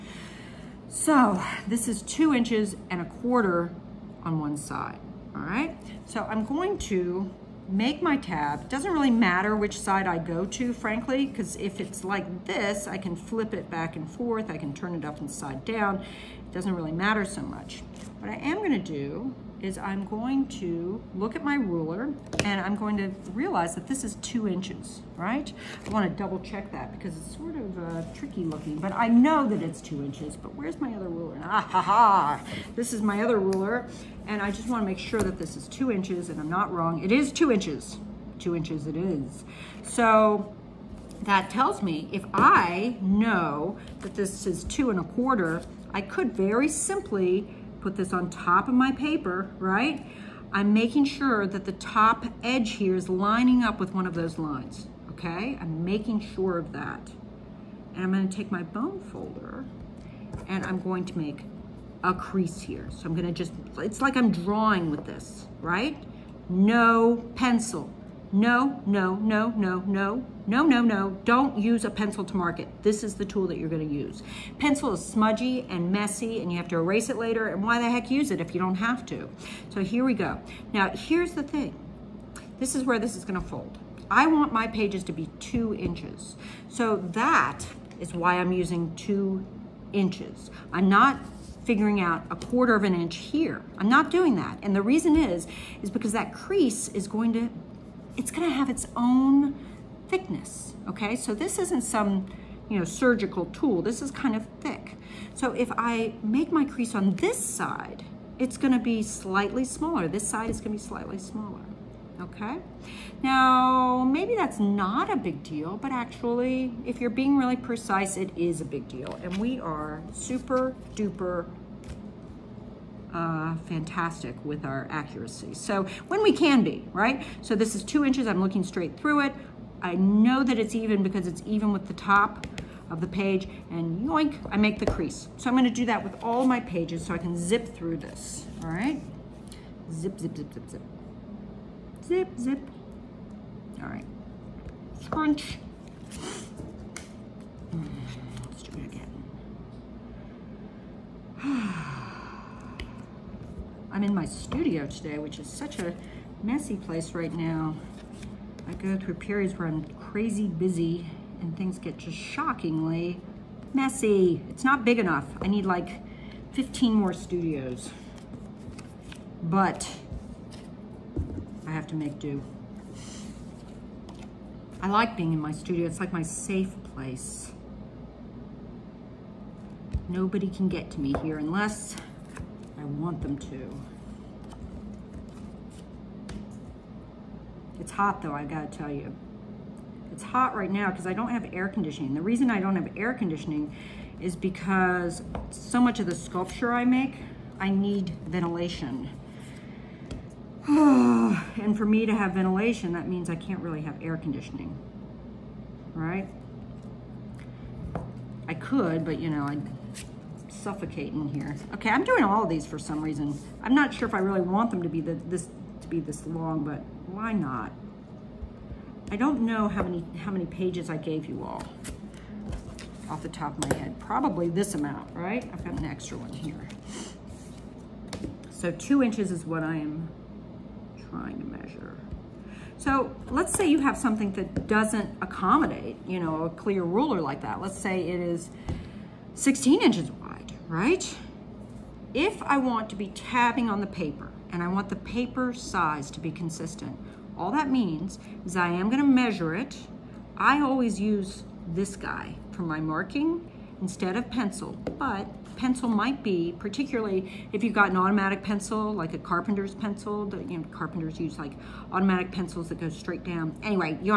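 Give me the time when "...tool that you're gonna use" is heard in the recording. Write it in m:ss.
1:13.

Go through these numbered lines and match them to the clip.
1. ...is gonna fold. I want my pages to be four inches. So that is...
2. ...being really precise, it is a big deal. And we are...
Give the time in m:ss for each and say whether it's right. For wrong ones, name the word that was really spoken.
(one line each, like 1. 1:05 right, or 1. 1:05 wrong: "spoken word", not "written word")
1. 1:23 wrong: "two", not "four"
2. 1:57 right.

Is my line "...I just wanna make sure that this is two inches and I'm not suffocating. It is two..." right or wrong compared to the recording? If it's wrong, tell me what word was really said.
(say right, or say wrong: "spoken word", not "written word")
wrong: "wrong", not "suffocating".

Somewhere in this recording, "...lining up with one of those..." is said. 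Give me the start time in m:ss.
0:53.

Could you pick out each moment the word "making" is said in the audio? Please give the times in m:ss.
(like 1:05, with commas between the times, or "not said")
0:50, 0:55.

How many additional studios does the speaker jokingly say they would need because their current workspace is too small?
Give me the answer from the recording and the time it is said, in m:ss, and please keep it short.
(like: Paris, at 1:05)
15, at 2:46.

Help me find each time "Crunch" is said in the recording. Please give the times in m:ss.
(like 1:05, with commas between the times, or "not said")
2:25.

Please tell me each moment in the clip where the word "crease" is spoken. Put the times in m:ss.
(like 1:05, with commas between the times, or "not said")
1:02, 1:36, 1:46, 2:14.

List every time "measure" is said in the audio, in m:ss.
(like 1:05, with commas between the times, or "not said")
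3:51, 4:09.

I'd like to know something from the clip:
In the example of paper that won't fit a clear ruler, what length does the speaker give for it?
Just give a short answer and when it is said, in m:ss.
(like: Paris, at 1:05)
16 inches, at 3:59.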